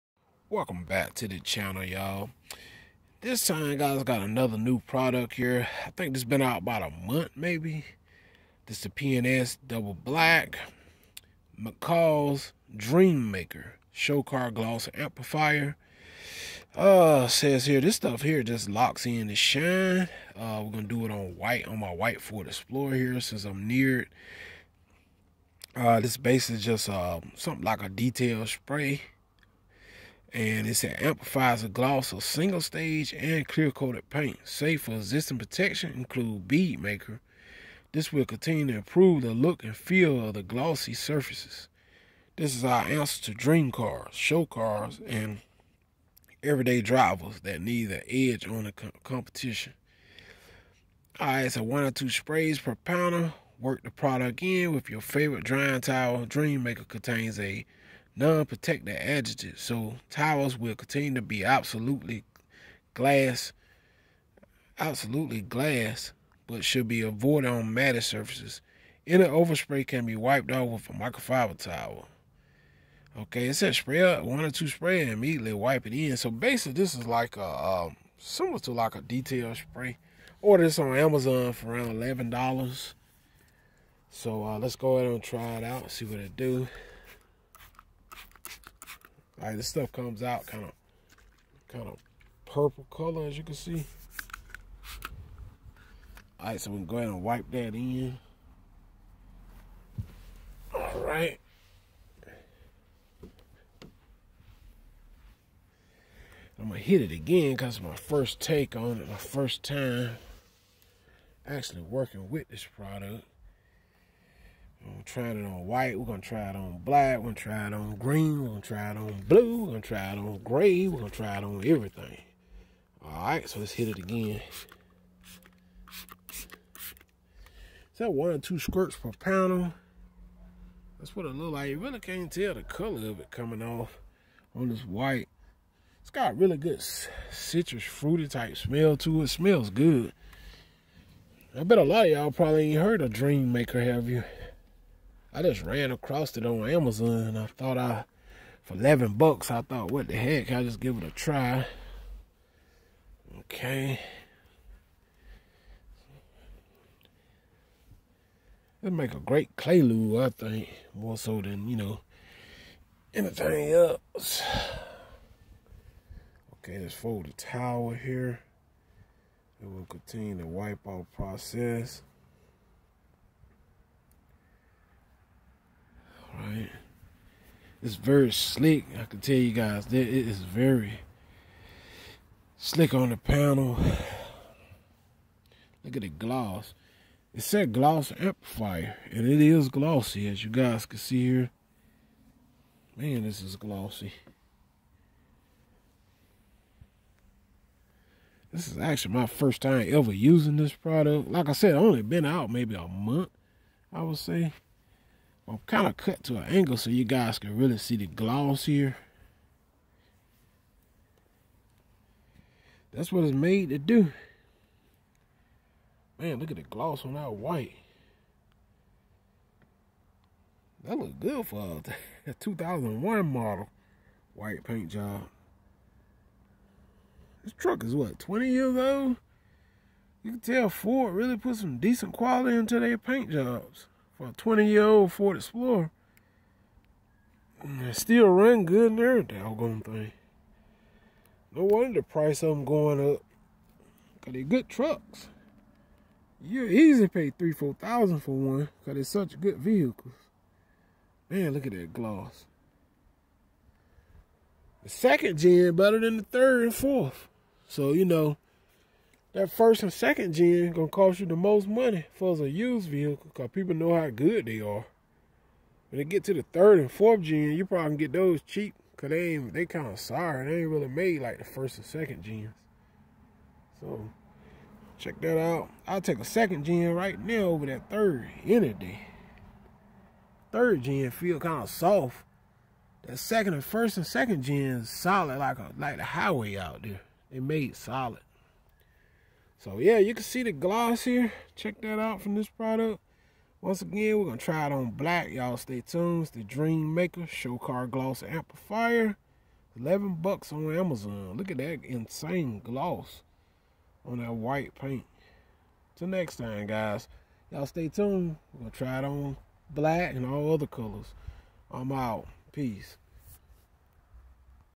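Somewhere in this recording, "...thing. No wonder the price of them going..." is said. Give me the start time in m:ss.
3:59.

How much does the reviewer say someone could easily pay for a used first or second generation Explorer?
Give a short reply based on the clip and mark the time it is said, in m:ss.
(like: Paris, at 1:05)
3,000 to 4,000 dollars, at 4:07.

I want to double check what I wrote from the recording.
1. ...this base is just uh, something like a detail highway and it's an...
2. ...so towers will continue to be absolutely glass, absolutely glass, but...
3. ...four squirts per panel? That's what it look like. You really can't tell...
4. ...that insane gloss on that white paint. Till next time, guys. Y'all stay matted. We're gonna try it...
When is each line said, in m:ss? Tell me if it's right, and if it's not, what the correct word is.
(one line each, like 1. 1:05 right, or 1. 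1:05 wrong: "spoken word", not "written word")
1. 0:26 wrong: "spray", not "highway"
2. 0:59 right
3. 2:08 wrong: "two", not "four"
4. 5:01 wrong: "tuned", not "matted".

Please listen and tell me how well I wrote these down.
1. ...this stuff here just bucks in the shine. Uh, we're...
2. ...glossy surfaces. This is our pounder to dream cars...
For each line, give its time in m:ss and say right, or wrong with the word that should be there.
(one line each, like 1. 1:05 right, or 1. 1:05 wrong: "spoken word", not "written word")
1. 0:17 wrong: "locks", not "bucks"
2. 0:40 wrong: "answer", not "pounder".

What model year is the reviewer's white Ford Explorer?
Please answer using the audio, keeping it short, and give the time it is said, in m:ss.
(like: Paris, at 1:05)
2001, at 3:42.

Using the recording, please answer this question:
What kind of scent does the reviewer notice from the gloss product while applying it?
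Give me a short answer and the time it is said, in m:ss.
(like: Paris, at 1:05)
Citrus fruity, at 2:17.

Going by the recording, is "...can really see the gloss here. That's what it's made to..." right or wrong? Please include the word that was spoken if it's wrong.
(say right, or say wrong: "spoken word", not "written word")
right.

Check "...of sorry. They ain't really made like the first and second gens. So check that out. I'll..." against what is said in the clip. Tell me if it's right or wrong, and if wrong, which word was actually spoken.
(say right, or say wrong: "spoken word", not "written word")
right.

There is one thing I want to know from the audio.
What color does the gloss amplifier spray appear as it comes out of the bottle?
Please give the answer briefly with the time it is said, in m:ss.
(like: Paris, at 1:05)
Purple, at 1:32.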